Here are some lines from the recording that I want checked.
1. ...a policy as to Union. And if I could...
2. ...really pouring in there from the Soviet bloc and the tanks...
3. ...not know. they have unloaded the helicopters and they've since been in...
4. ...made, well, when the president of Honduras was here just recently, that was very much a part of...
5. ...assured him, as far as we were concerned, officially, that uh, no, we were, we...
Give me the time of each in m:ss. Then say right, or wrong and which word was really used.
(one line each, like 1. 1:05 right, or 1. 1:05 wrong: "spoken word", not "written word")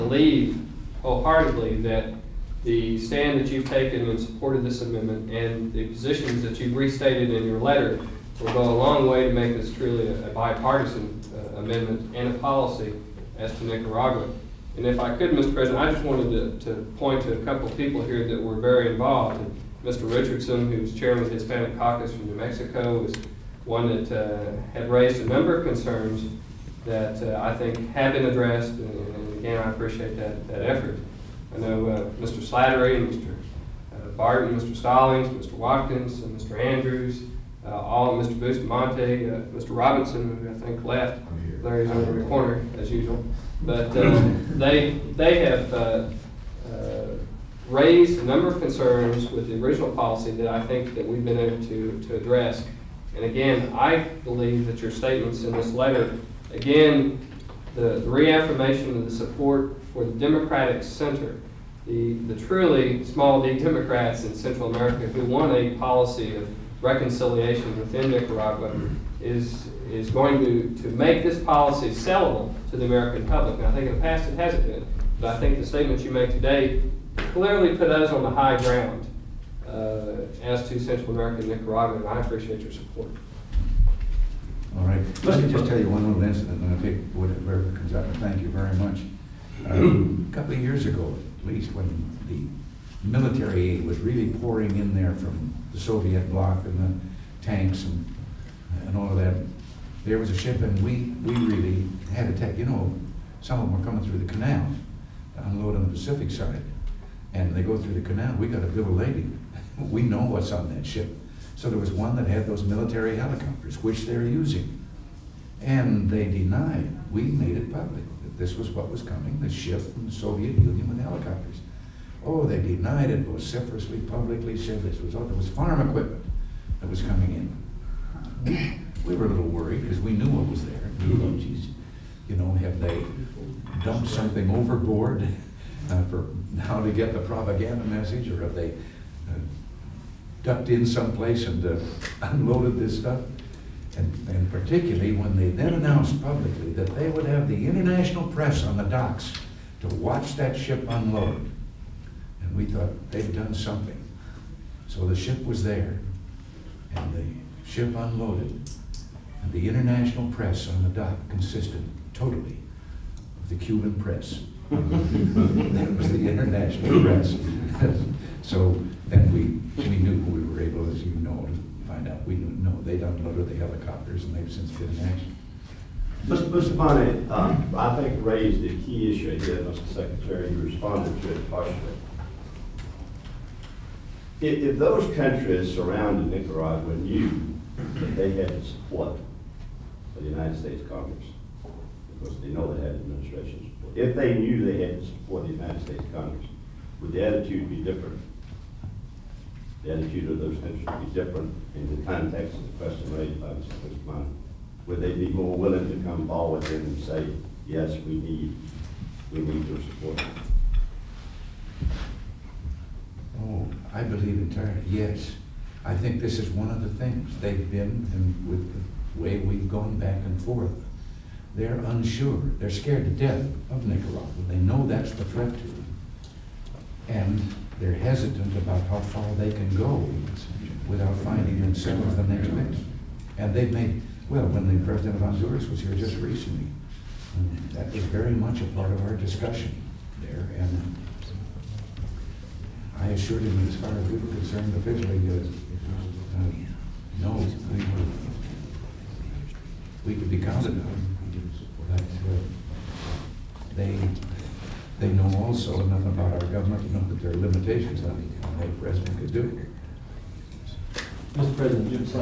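1. 0:12 wrong: "Nicaragua", not "Union"
2. 1:33 right
3. 2:52 right
4. 3:53 right
5. 4:03 right.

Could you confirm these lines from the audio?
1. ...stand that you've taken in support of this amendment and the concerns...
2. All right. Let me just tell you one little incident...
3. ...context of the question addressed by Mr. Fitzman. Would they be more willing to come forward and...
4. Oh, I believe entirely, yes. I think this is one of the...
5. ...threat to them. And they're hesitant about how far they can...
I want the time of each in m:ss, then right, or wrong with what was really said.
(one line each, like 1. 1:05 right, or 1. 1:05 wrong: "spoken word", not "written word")
1. 0:02 wrong: "positions", not "concerns"
2. 1:24 right
3. 3:22 wrong: "raised", not "addressed"
4. 3:33 right
5. 3:45 right.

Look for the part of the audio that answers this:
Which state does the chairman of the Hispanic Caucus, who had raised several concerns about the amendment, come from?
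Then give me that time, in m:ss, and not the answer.
0:22.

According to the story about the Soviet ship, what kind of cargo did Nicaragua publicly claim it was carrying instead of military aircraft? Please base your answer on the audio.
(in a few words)
Farm equipment.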